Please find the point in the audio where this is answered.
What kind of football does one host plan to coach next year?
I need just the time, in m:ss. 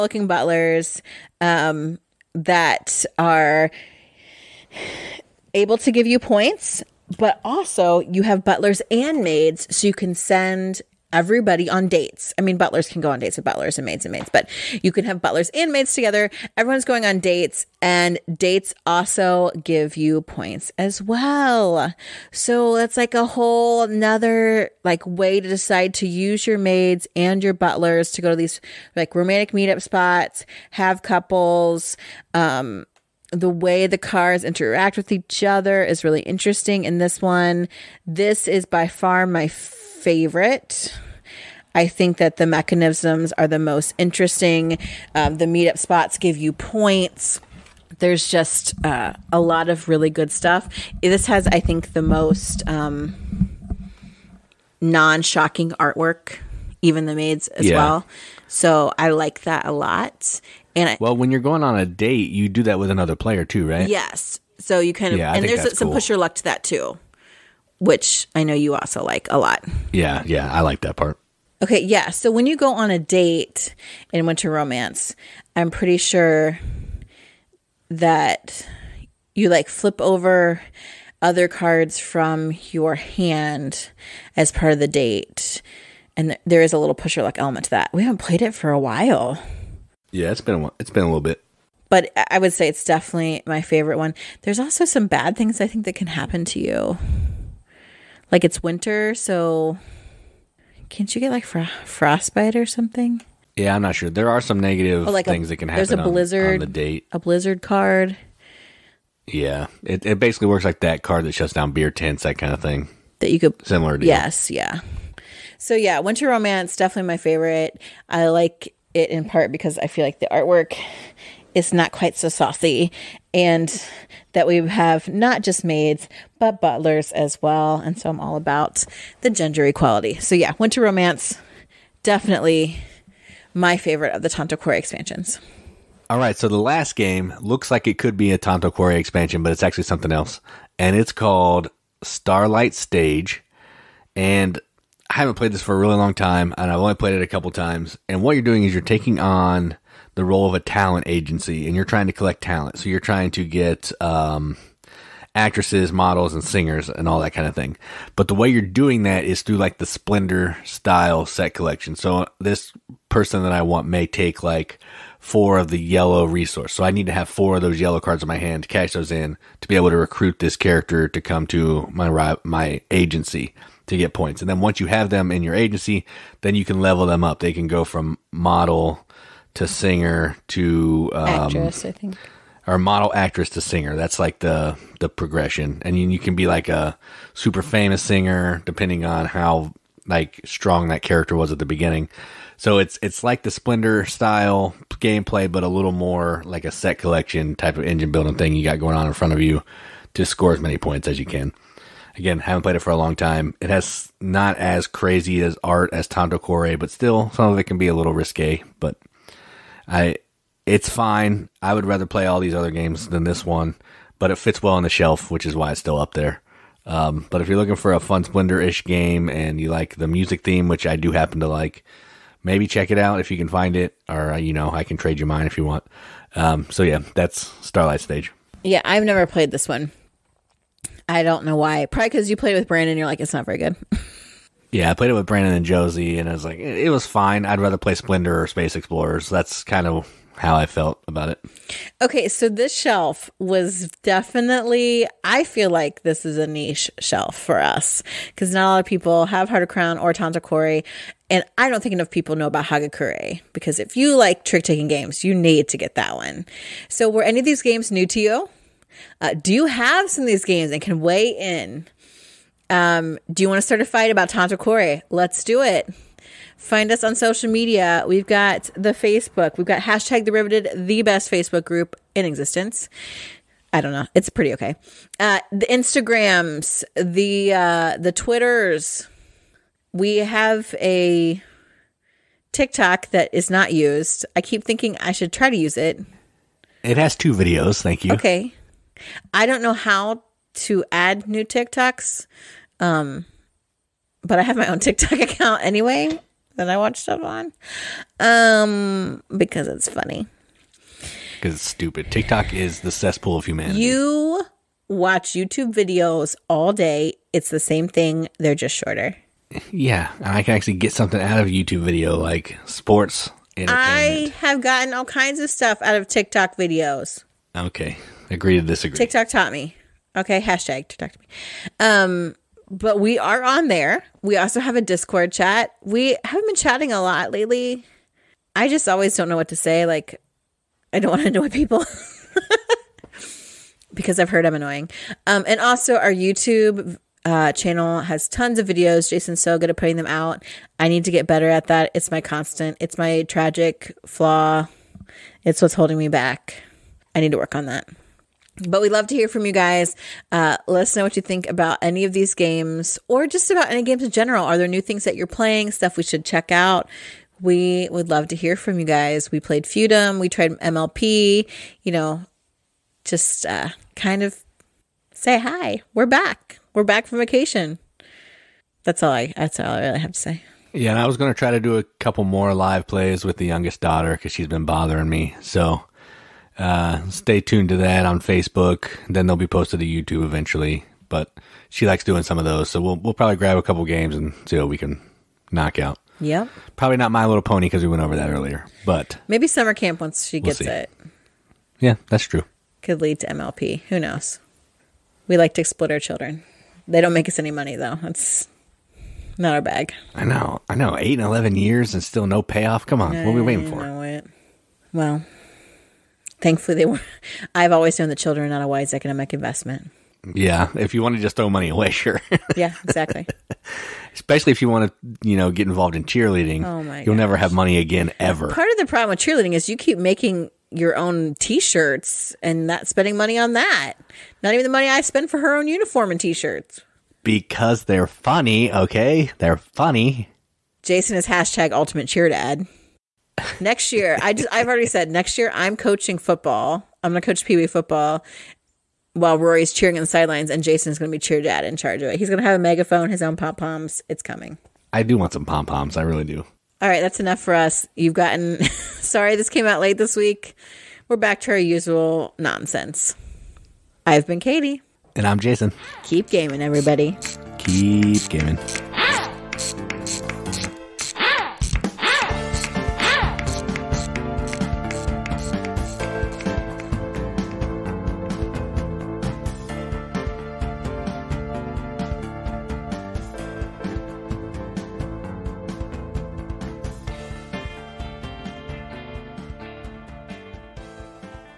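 7:17.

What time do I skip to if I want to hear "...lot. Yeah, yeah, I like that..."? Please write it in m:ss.
1:09.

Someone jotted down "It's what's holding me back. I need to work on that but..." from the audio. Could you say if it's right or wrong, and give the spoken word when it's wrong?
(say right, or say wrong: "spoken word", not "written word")
right.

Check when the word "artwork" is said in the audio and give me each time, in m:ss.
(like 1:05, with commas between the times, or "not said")
0:55, 2:00.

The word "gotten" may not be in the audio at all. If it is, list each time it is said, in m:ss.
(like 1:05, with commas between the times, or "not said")
5:14, 7:28.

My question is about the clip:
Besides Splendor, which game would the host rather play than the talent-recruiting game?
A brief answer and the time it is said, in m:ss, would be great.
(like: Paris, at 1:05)
Space Explorers, at 3:58.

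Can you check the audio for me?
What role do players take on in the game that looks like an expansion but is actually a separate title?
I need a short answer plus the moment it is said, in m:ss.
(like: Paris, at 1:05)
A talent agency, at 2:30.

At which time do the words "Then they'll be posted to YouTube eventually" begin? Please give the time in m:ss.
6:19.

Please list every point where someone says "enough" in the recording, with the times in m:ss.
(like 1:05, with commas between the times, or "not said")
4:11, 7:27.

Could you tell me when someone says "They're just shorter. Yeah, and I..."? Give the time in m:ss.
5:08.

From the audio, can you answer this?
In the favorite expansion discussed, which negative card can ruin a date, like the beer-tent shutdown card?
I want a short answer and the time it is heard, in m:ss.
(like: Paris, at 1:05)
Blizzard card, at 1:47.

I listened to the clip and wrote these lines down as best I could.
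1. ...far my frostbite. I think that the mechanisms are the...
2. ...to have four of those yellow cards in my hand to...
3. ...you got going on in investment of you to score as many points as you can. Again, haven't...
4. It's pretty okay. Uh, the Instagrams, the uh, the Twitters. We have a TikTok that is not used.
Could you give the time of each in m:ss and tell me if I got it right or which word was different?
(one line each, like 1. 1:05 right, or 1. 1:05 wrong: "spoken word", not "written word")
1. 0:38 wrong: "favorite", not "frostbite"
2. 2:47 right
3. 3:18 wrong: "front", not "investment"
4. 4:34 right.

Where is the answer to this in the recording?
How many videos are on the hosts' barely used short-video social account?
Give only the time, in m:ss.
4:47.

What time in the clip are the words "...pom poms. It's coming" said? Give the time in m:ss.
7:23.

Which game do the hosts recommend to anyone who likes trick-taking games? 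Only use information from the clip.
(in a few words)
Hagakure.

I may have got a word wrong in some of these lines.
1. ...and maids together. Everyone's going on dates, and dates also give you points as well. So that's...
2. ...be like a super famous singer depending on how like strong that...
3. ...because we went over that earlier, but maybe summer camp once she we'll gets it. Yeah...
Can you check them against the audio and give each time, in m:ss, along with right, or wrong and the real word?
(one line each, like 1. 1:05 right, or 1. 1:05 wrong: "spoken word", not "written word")
1. 0:15 right
2. 3:06 right
3. 6:27 right.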